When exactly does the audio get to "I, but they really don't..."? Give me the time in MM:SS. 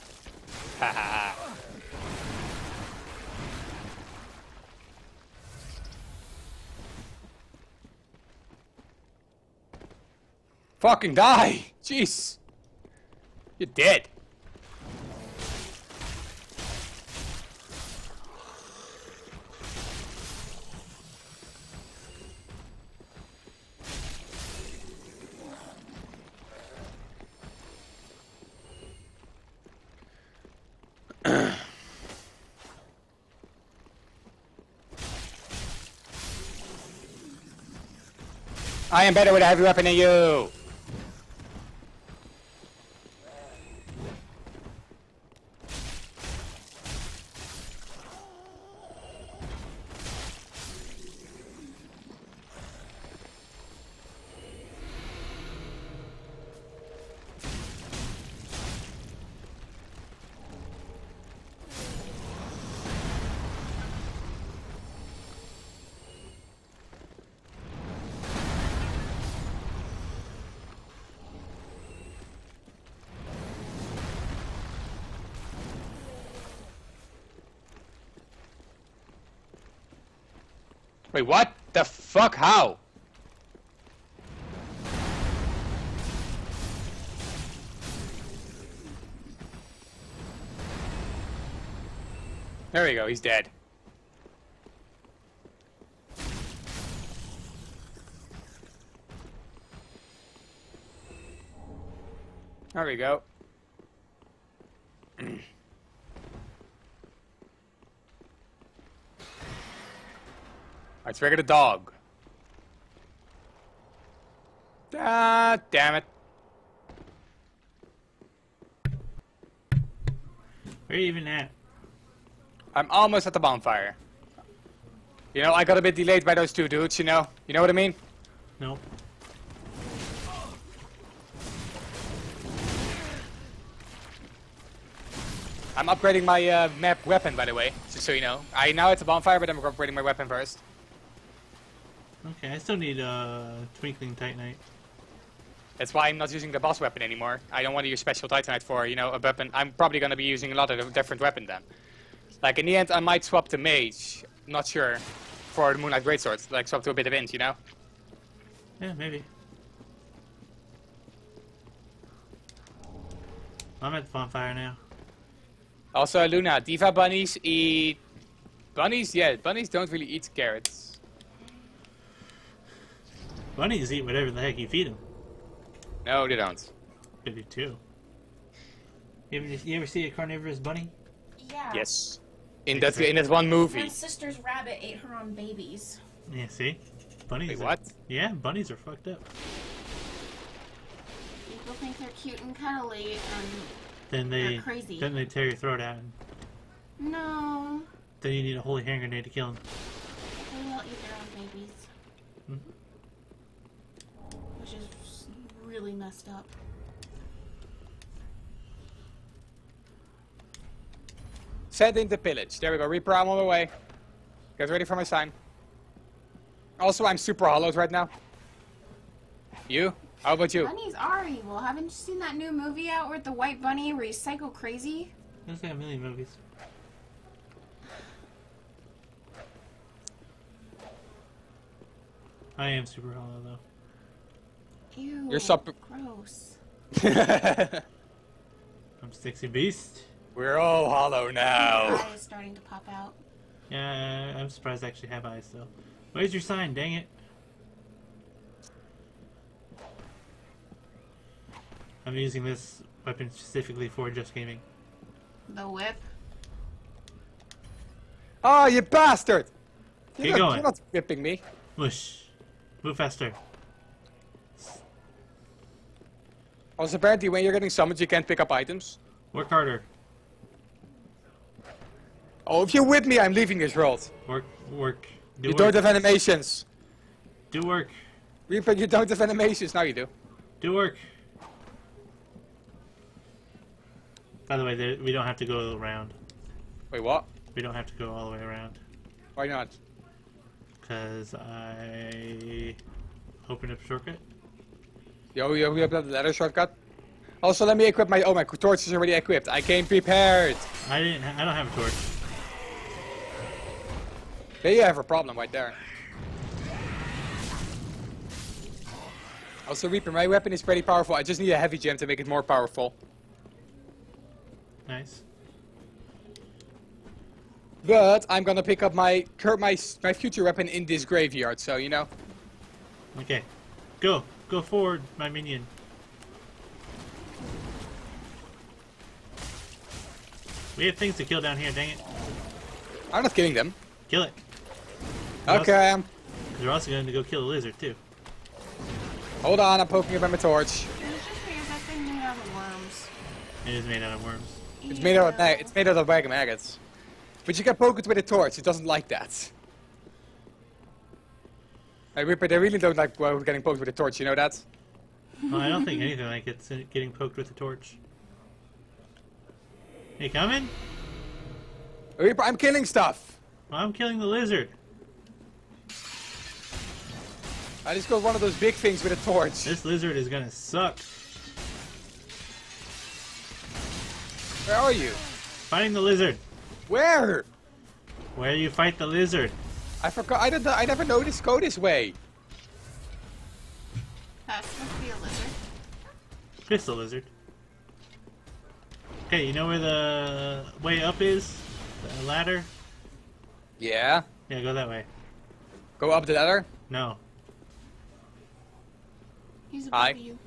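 05:52.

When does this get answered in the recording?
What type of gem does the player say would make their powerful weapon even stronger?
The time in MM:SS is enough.
05:11.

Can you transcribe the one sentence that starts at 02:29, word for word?
I'm probably going to be using a lot of different weapon then.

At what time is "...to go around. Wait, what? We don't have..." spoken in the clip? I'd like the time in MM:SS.
04:45.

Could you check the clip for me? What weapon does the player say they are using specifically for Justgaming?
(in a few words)
The whip.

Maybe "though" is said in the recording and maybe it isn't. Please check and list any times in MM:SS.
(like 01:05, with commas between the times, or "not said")
03:53, 04:05.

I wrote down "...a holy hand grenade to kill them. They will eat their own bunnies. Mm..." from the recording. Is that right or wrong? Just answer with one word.
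wrong.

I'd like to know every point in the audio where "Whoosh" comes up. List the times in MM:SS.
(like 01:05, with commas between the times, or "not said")
04:21.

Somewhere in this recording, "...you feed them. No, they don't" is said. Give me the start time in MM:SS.
02:54.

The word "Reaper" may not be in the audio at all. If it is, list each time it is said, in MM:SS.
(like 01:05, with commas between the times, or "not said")
03:32, 04:38, 05:09, 06:02.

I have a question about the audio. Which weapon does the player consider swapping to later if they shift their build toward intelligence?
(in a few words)
Moonlight Greatsword.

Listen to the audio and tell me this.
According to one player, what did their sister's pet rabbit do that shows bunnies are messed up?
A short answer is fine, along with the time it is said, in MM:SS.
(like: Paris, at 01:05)
Ate her own babies, at 03:04.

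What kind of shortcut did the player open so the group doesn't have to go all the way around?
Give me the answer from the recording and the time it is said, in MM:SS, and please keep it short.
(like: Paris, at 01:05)
Ladder shortcut, at 04:56.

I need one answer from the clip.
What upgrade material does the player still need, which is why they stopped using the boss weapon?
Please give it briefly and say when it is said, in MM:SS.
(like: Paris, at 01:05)
Twinkling Titanite, at 02:23.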